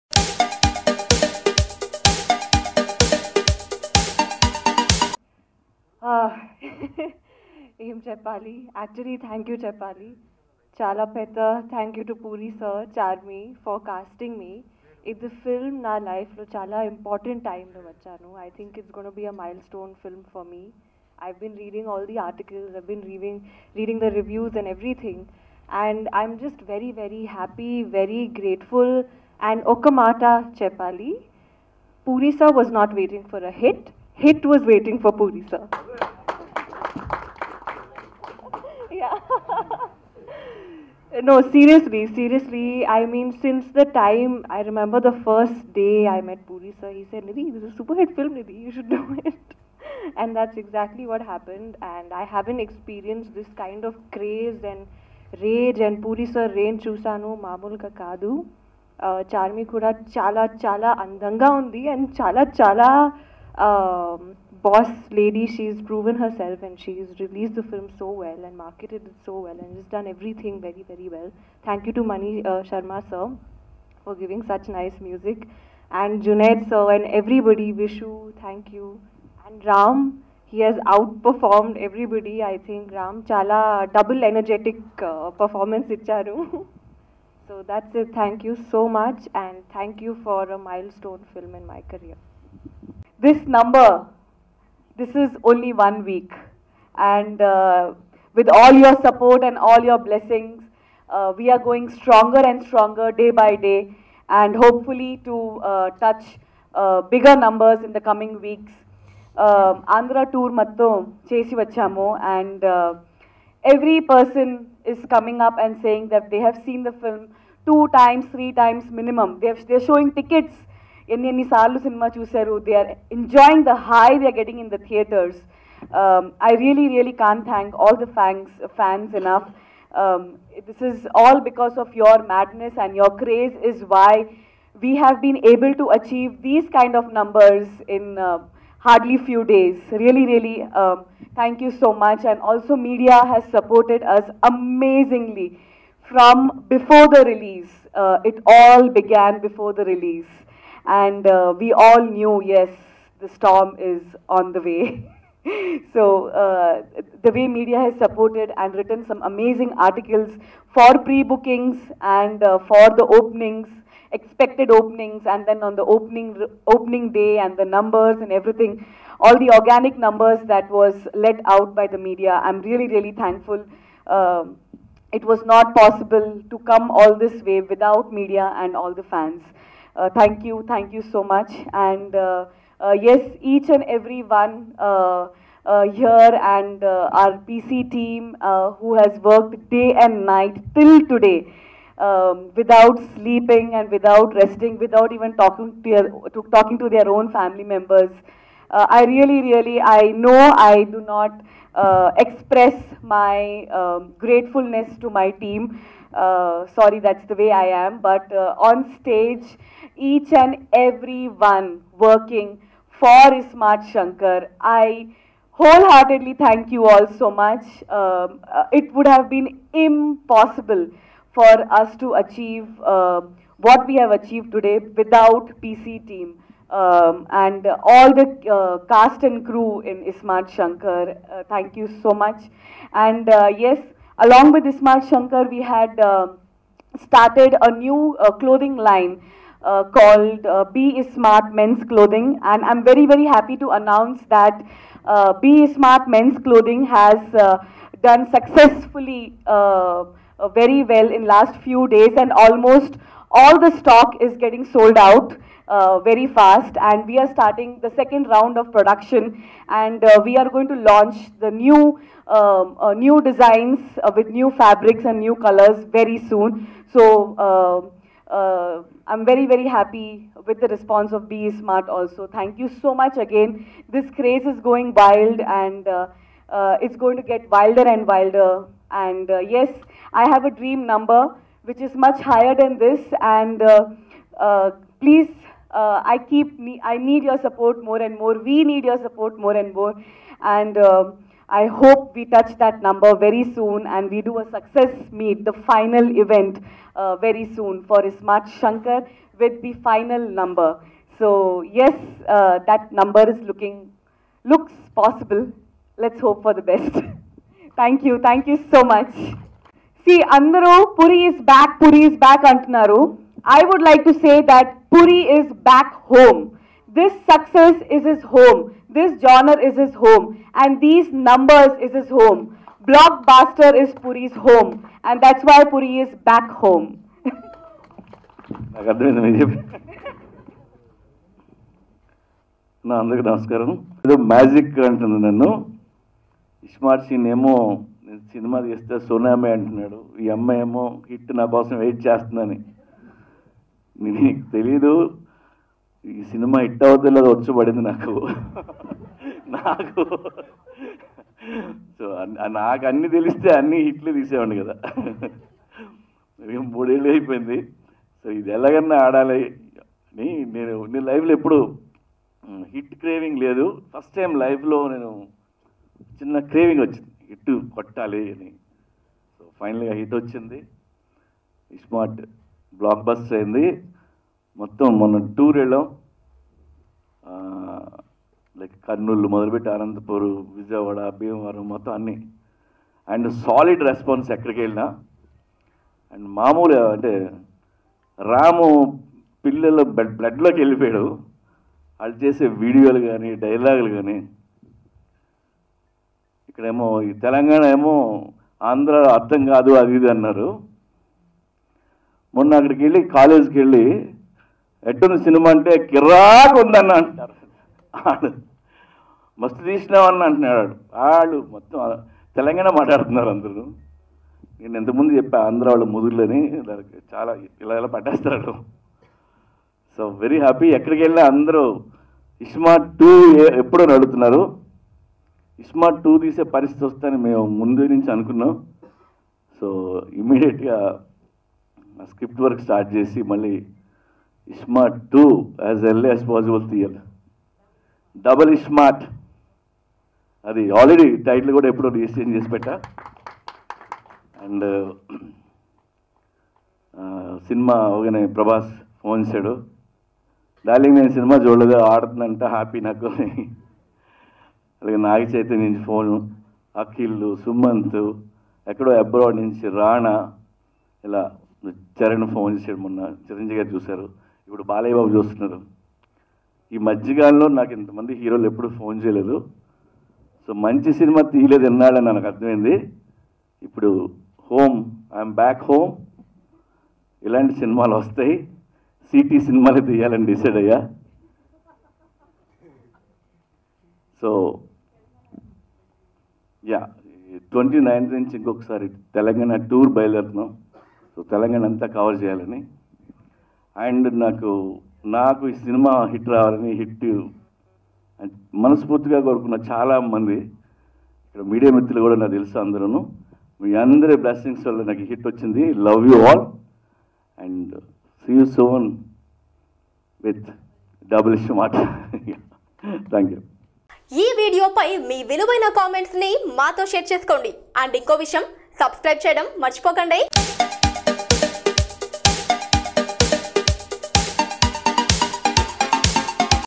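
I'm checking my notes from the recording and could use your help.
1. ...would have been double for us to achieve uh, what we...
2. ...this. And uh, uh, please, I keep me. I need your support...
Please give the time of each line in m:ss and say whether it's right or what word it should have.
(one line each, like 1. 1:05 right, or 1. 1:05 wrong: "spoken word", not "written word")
1. 3:38 wrong: "impossible", not "double"
2. 4:42 right.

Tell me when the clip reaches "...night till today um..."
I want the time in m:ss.
3:10.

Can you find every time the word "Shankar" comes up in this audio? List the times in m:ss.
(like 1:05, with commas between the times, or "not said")
3:33, 3:50, 3:55, 4:58.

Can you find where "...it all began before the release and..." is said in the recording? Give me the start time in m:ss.
2:28.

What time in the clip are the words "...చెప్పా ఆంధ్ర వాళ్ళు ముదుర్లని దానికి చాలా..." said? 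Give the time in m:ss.
6:55.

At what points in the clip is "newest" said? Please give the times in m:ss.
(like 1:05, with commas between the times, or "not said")
not said.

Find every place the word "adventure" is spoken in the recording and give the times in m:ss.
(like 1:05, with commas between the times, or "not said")
not said.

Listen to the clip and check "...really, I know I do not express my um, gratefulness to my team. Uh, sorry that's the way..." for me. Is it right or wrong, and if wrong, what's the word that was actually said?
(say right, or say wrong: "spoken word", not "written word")
right.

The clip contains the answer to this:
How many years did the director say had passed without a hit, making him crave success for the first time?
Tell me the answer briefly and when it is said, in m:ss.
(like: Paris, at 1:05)
3 years, at 5:56.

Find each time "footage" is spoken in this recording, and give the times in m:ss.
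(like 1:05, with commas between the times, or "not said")
not said.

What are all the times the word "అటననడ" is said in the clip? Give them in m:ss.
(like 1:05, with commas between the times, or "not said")
5:39, 6:50.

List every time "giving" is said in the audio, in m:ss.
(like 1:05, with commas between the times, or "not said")
1:14.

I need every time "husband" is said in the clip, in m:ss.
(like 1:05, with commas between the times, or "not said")
not said.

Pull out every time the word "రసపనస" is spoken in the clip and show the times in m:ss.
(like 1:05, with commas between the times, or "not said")
6:23.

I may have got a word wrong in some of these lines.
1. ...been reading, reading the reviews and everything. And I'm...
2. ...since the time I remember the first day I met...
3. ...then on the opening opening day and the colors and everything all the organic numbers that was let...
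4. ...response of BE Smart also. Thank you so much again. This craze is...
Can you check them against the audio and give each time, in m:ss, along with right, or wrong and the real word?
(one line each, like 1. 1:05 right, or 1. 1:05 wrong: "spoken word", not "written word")
1. 0:22 right
2. 0:43 right
3. 2:45 wrong: "numbers", not "colors"
4. 4:30 right.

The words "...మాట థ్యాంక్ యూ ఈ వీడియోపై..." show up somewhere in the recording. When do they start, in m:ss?
8:31.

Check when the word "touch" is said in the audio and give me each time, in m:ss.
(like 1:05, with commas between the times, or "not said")
1:45, 4:52.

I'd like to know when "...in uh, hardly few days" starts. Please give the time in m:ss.
2:17.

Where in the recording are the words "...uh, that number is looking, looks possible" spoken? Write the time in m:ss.
5:02.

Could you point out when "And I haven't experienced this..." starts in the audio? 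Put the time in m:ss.
0:51.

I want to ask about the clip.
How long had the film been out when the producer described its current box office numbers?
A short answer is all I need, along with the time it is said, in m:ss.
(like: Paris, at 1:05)
one week, at 1:35.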